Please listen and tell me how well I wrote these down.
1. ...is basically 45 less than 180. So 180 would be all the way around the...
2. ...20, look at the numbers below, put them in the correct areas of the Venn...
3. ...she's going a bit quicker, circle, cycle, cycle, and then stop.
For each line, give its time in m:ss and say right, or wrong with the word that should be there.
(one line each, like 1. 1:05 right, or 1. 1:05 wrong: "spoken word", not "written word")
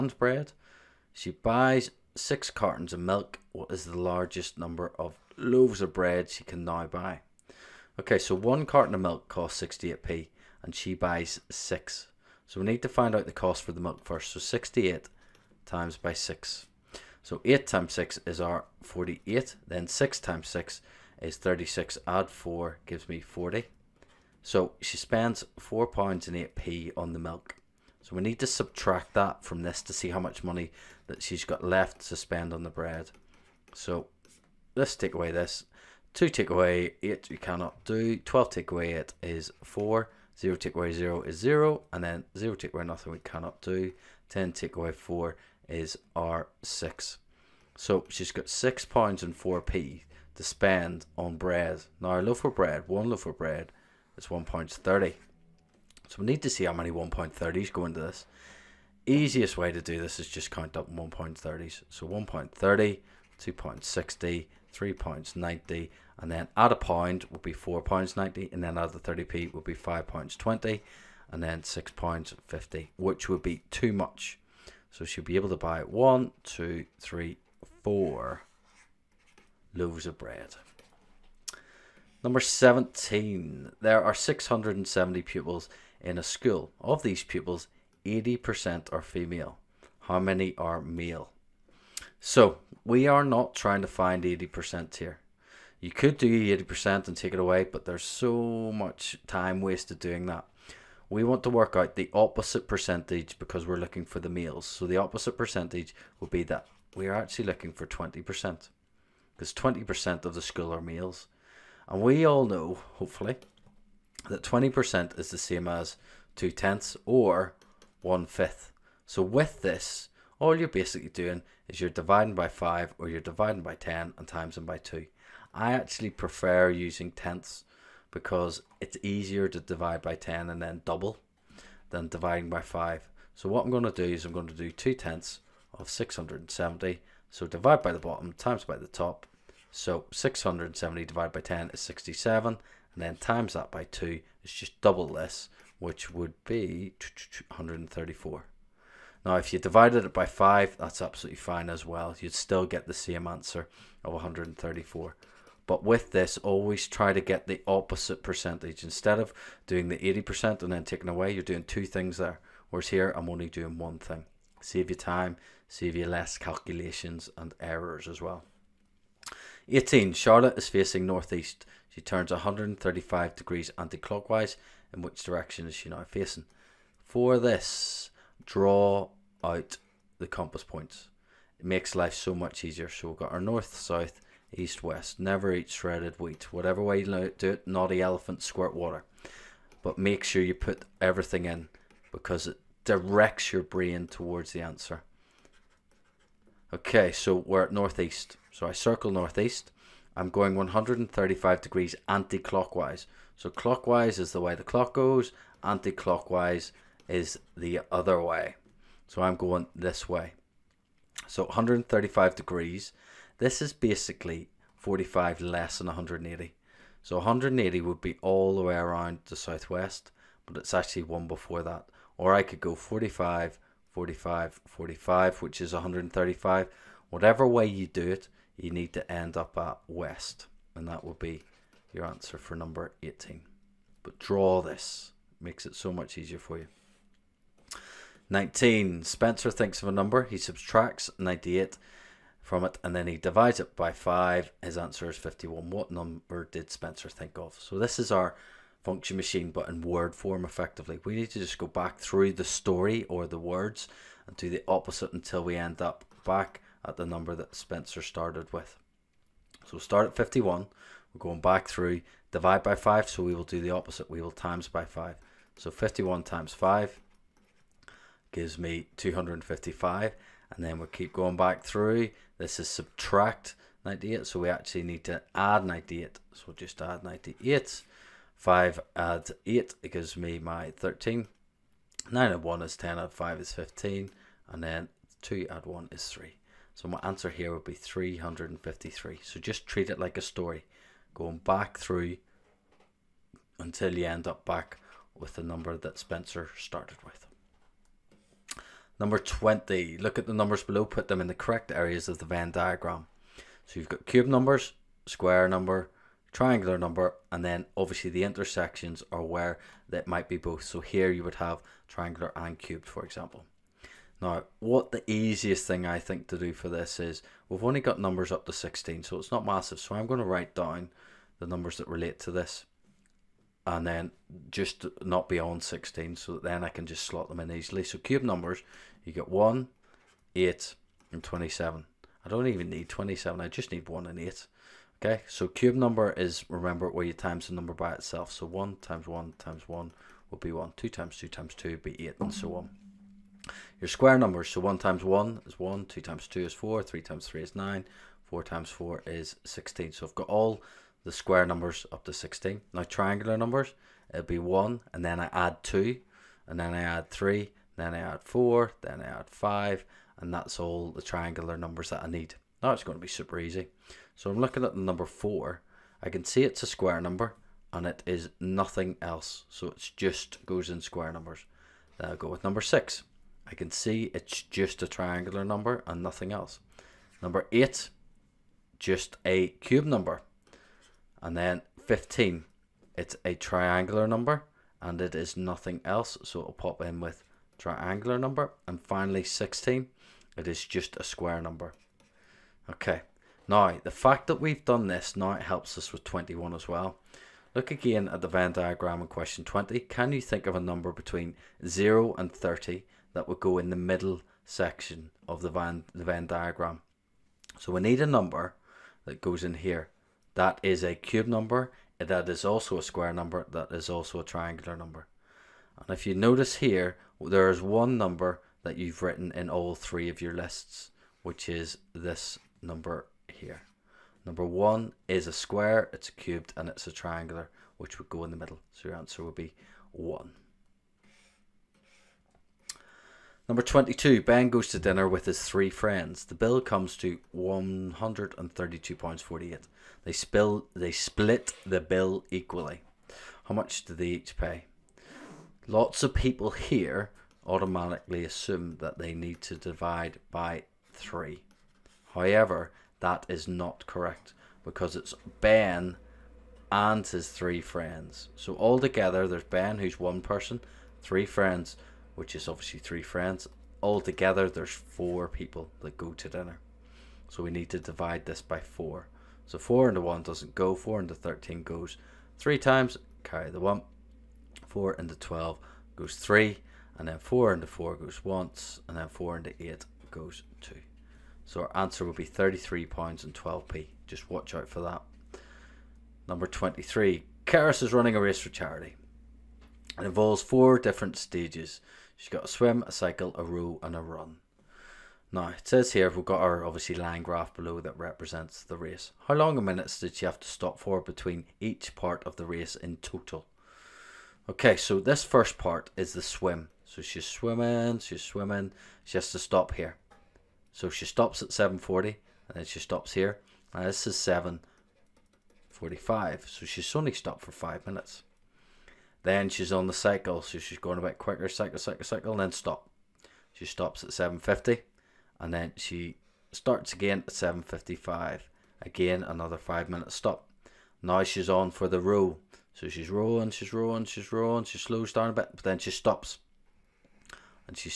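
1. 3:33 right
2. 4:59 right
3. 8:40 wrong: "cycle", not "circle".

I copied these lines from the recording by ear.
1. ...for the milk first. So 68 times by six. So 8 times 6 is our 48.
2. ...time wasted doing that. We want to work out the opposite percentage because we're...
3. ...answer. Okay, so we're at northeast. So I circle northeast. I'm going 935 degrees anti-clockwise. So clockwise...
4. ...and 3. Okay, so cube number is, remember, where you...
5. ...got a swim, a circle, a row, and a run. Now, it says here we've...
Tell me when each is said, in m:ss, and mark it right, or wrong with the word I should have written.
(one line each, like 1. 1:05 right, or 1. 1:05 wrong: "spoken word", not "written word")
1. 0:13 right
2. 1:39 right
3. 3:14 wrong: "135", not "935"
4. 5:34 wrong: "8", not "3"
5. 8:12 wrong: "cycle", not "circle".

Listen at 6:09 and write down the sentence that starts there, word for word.
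So it just goes in square numbers.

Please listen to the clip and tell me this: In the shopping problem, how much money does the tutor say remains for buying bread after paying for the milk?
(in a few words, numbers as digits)
£6.04.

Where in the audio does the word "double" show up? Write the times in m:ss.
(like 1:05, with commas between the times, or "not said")
2:10, 2:24.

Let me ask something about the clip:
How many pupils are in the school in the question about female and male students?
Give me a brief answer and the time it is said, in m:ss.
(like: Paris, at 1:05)
670, at 1:24.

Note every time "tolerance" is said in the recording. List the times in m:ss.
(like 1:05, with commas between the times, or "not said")
not said.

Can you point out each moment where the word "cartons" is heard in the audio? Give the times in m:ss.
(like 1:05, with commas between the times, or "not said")
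0:02, 0:08.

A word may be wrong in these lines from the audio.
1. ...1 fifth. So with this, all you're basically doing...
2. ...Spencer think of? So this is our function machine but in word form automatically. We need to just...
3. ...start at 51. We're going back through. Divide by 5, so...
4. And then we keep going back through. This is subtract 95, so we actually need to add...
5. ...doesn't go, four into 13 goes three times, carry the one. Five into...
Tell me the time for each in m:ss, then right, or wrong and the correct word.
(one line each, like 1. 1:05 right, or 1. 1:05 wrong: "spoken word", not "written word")
1. 1:58 right
2. 4:06 wrong: "effectively", not "automatically"
3. 4:19 right
4. 4:30 wrong: "98", not "95"
5. 7:50 wrong: "Four", not "Five".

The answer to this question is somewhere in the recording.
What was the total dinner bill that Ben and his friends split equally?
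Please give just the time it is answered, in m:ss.
7:17.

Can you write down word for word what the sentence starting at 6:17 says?
Number 8, just a cube number.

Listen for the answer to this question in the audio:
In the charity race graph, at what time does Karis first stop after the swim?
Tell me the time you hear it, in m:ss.
8:31.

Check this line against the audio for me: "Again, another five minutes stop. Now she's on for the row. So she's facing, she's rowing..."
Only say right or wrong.
wrong.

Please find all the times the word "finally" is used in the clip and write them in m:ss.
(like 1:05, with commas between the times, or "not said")
6:28.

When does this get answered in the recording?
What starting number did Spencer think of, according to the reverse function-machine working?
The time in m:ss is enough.
4:47.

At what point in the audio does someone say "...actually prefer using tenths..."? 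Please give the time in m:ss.
2:05.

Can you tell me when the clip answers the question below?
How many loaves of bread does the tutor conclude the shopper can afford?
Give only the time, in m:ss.
1:17.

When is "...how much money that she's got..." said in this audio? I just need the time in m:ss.
0:30.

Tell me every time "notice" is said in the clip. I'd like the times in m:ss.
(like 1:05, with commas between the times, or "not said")
6:56.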